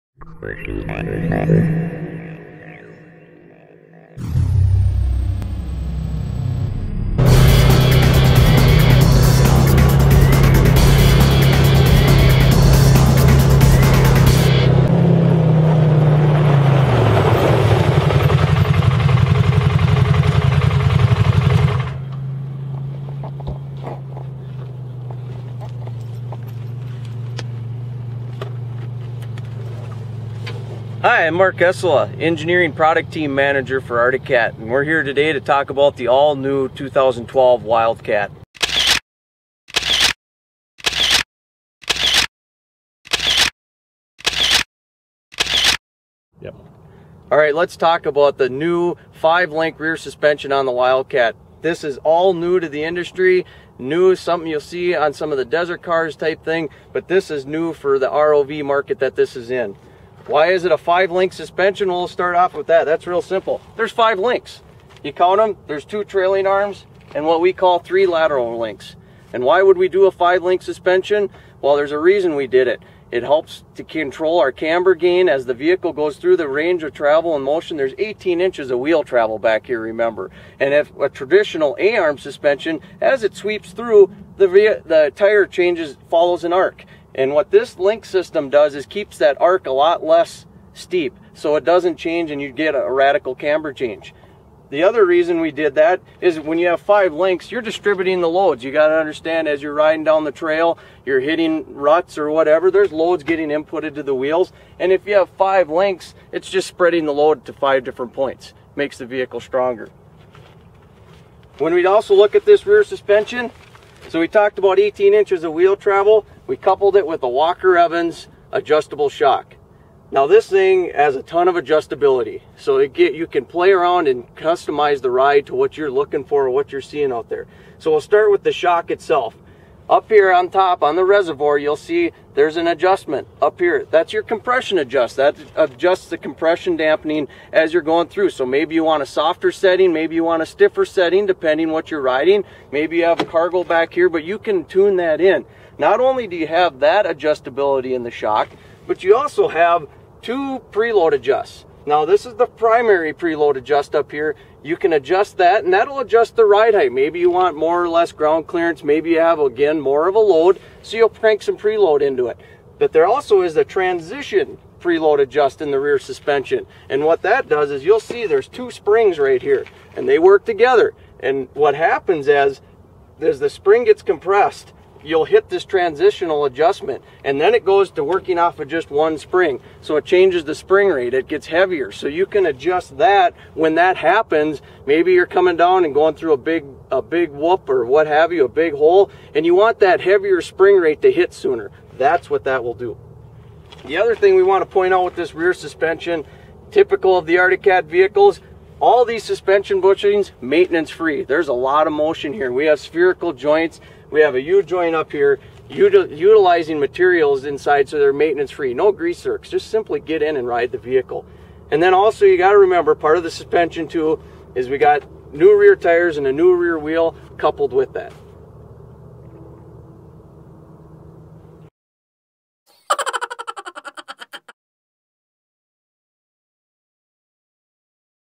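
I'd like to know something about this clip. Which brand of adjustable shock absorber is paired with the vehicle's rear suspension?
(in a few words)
Walker Evans.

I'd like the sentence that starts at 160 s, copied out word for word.
So you'll crank some preload into it.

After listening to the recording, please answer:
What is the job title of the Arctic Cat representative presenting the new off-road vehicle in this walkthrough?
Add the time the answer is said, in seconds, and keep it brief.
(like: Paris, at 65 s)
Engineering Product Team Manager, at 32 s.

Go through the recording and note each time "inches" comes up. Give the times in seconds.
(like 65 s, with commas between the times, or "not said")
78 s, 115 s.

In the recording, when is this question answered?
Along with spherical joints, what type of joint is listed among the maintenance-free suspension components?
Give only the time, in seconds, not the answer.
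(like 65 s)
204 s.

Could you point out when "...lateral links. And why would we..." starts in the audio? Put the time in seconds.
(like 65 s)
68 s.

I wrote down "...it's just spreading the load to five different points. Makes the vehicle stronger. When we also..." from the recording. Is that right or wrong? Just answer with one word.
right.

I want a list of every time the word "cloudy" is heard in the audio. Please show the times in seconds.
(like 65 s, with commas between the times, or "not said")
not said.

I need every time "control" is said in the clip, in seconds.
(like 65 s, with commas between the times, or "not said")
73 s.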